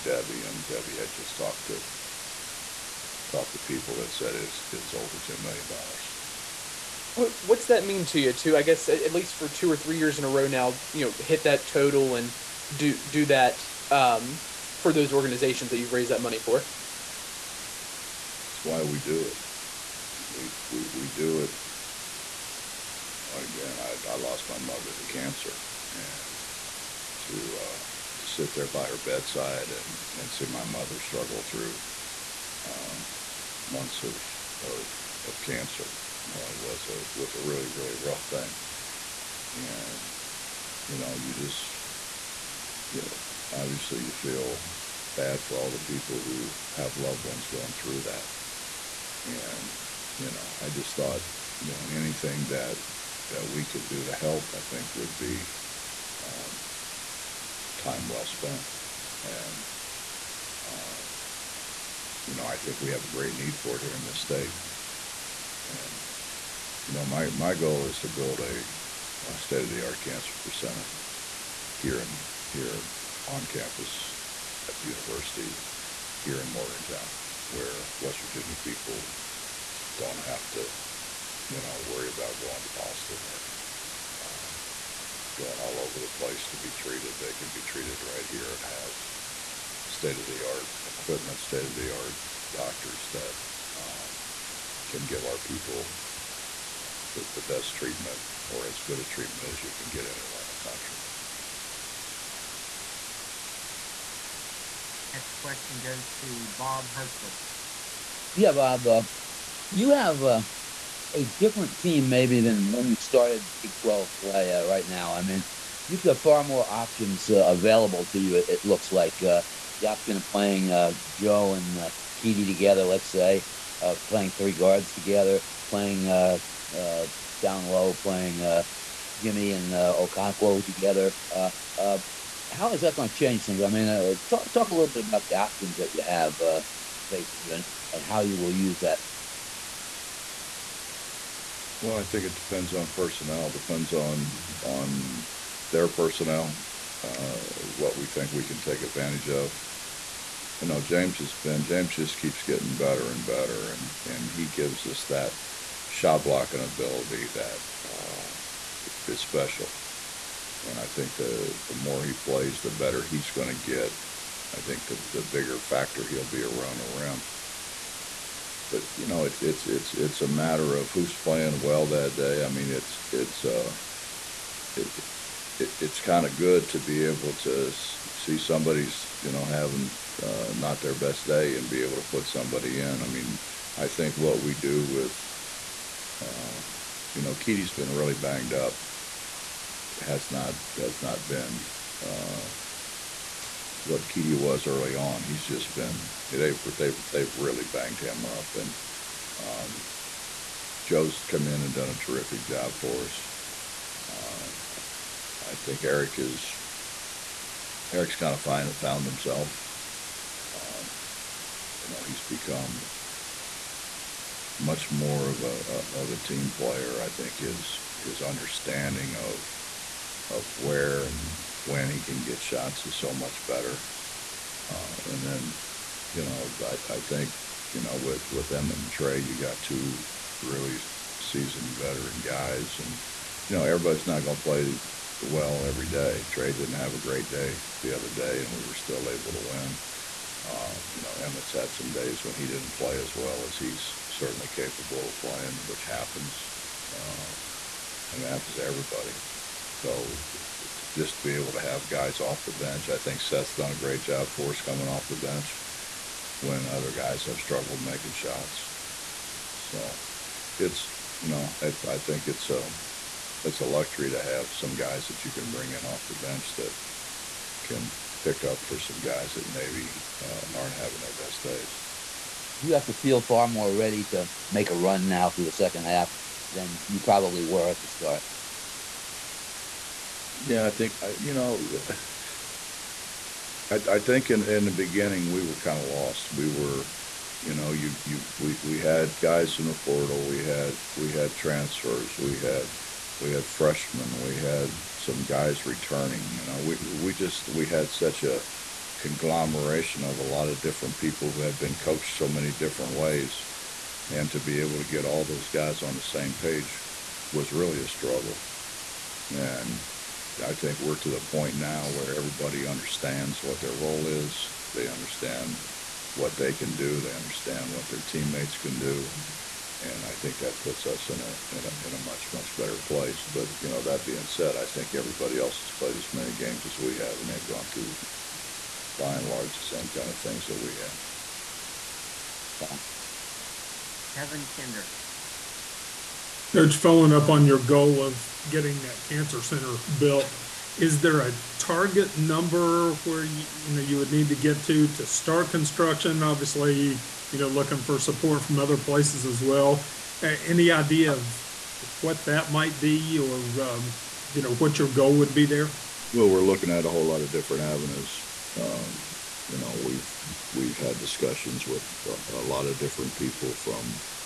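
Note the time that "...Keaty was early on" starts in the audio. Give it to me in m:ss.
3:14.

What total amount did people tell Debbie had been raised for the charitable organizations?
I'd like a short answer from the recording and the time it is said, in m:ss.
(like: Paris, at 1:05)
over $10 million, at 0:04.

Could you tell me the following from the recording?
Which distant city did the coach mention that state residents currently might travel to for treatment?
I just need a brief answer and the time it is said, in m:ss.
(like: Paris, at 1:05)
Boston, at 1:22.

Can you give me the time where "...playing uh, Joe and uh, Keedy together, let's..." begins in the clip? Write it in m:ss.
2:00.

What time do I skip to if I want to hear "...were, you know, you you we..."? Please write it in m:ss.
4:46.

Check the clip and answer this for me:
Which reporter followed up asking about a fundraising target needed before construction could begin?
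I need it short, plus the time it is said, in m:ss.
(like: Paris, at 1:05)
Kevin Kinder, at 5:34.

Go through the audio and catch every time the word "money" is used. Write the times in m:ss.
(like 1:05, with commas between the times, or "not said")
0:16.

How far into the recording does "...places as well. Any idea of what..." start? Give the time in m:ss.
5:48.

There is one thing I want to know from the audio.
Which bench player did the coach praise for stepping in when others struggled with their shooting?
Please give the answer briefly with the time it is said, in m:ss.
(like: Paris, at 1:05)
Seth, at 4:13.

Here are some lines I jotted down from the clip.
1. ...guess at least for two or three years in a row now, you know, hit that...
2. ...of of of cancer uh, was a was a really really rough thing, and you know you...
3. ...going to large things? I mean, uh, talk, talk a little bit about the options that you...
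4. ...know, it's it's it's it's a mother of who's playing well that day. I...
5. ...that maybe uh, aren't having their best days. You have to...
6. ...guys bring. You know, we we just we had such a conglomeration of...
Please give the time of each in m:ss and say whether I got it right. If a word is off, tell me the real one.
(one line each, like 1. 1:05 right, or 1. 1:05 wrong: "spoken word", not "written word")
1. 0:08 right
2. 0:34 right
3. 2:12 wrong: "change", not "large"
4. 2:49 wrong: "matter", not "mother"
5. 4:29 right
6. 4:55 wrong: "returning", not "bring".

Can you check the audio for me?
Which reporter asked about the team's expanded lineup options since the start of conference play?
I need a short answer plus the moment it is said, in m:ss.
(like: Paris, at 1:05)
Bob Hertzel, at 1:46.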